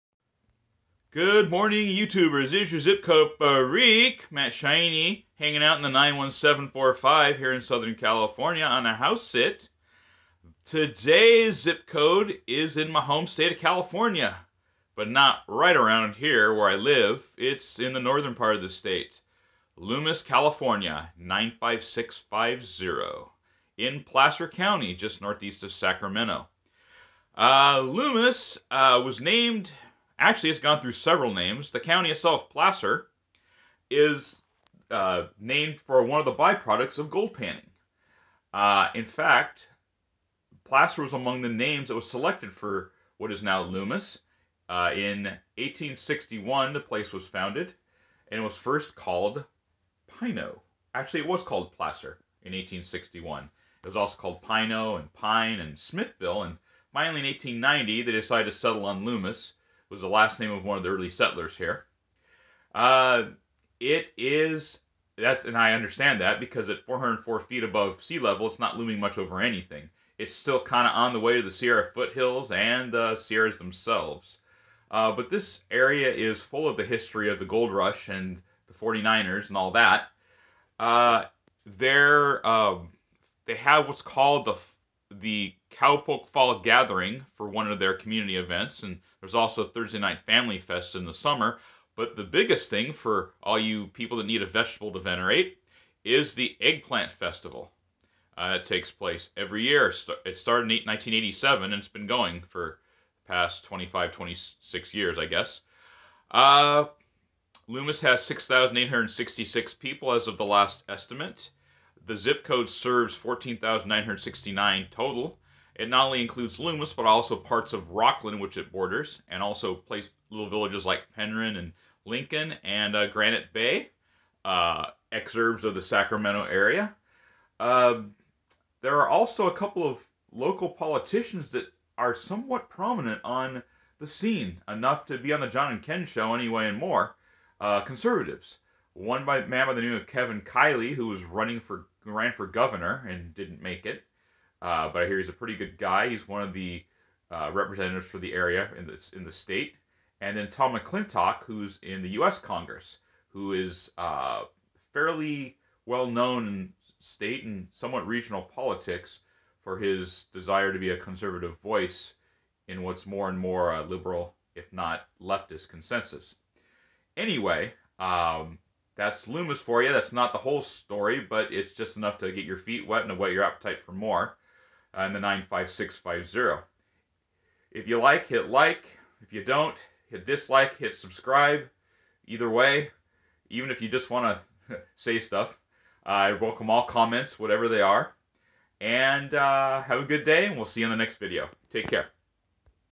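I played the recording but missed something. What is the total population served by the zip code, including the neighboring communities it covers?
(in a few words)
14,969.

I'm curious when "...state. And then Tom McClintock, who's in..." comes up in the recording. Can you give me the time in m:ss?
2:29.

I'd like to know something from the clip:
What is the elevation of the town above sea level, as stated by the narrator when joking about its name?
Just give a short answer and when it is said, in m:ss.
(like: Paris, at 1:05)
404 feet, at 1:06.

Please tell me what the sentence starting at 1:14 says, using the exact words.
Uh, but this area is full of the history of the gold rush and the 49ers and all that.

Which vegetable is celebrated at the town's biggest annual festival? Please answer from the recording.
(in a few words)
Eggplant.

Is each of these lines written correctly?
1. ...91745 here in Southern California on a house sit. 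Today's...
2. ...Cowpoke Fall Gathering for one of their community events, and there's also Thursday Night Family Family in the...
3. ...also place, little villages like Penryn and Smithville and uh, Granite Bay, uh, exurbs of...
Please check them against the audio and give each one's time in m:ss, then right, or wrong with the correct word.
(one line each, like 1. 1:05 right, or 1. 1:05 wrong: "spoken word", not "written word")
1. 0:05 right
2. 1:25 wrong: "Fest", not "Family"
3. 1:59 wrong: "Lincoln", not "Smithville".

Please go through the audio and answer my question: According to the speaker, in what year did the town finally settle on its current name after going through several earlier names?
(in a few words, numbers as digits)
1890.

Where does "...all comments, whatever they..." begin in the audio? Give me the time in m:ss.
3:06.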